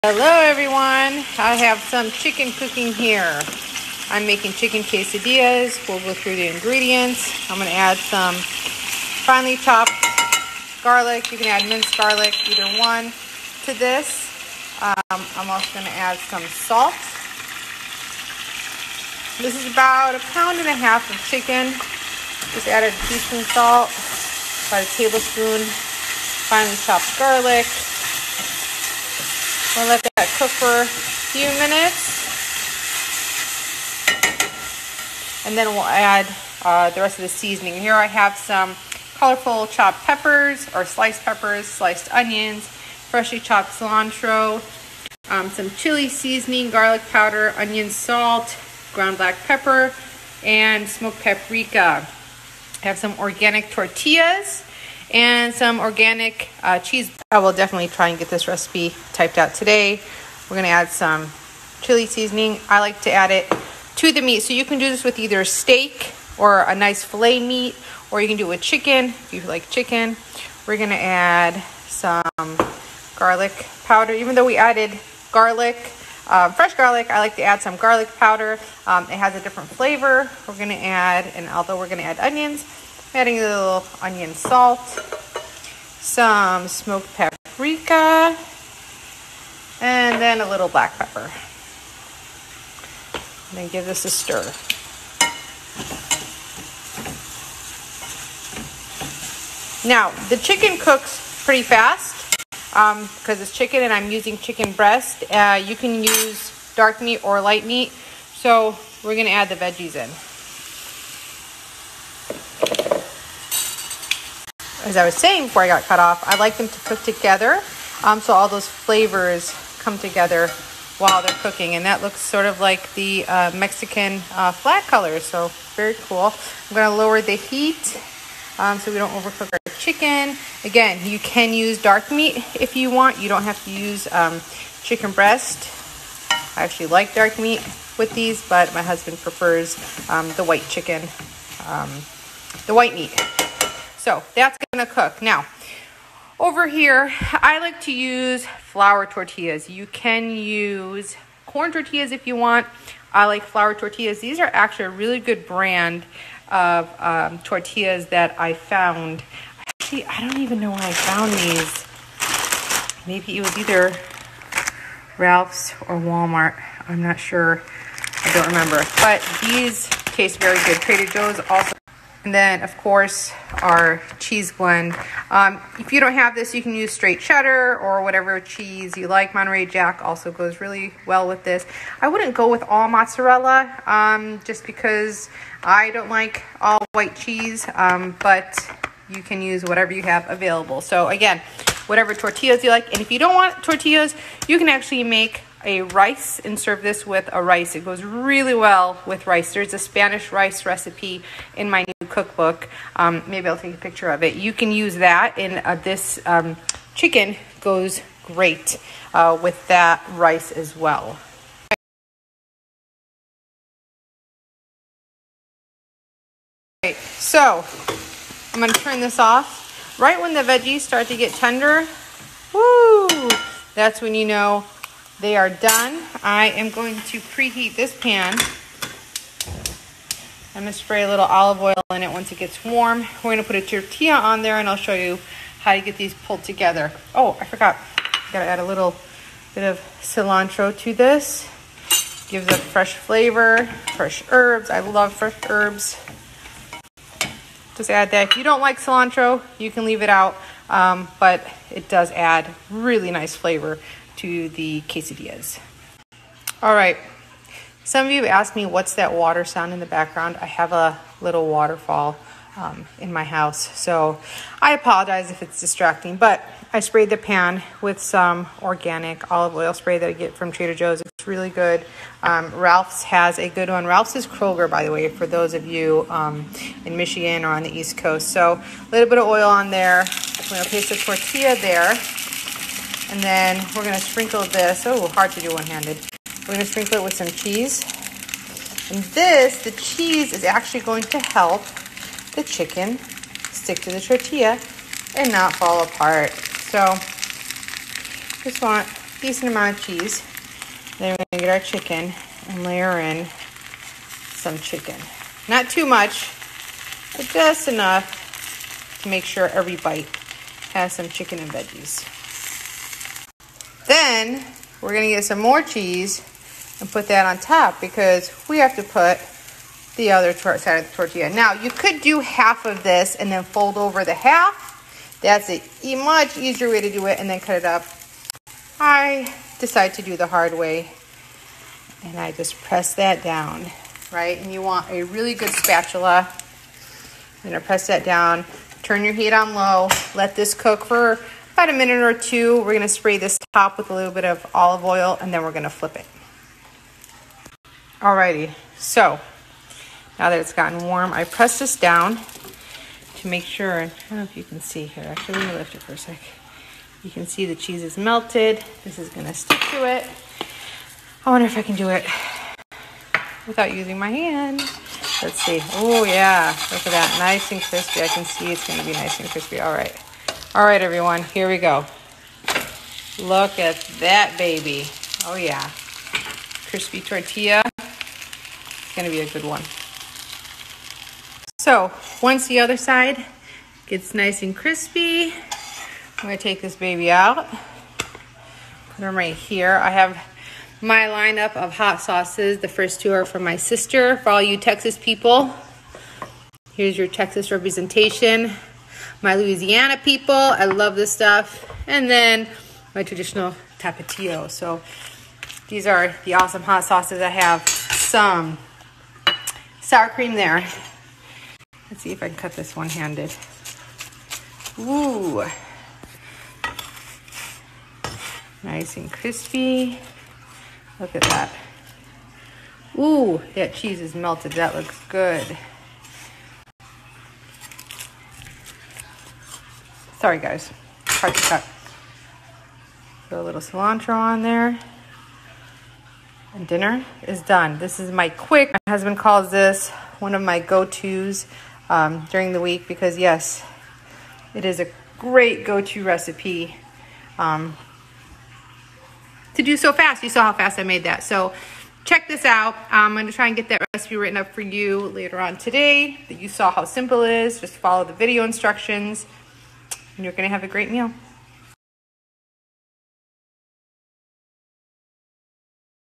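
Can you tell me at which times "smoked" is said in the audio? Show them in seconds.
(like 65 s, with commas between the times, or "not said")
50 s, 86 s.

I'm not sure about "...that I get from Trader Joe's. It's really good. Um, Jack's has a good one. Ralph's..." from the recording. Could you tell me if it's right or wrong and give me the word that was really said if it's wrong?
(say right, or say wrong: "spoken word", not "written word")
wrong: "Ralph", not "Jack".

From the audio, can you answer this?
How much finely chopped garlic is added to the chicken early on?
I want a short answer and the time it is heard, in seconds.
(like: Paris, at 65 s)
1 tablespoon, at 24 s.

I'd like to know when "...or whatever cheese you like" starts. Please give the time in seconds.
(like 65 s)
177 s.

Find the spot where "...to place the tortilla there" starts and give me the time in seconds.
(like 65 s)
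280 s.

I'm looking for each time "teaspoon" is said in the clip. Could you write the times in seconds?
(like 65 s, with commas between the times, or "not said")
23 s.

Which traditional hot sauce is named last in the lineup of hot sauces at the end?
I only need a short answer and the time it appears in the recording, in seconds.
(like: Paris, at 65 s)
Tapatio, at 403 s.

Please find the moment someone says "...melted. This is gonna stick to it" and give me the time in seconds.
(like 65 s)
357 s.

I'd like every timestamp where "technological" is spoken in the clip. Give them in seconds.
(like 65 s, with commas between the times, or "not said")
not said.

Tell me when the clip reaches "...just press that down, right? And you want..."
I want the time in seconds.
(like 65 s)
332 s.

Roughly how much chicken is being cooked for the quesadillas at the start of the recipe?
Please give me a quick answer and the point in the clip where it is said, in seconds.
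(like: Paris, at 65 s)
1.5 pounds, at 20 s.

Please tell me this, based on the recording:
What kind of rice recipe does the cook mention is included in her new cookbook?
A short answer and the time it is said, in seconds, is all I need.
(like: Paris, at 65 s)
Spanish rice, at 199 s.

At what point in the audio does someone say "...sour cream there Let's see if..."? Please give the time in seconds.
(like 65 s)
409 s.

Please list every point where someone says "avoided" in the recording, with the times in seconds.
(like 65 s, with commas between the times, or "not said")
not said.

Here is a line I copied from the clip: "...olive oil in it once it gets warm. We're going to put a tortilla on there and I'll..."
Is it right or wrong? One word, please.
right.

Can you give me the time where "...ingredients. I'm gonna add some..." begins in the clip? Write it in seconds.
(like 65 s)
6 s.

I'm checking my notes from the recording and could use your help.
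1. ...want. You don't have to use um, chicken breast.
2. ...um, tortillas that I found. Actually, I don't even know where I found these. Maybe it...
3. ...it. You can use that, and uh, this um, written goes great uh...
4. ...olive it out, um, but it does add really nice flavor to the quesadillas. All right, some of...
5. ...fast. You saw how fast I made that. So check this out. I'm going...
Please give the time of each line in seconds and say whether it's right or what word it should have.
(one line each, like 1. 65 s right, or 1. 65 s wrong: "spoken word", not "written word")
1. 132 s right
2. 156 s right
3. 204 s wrong: "chicken", not "written"
4. 249 s wrong: "leave", not "olive"
5. 449 s right.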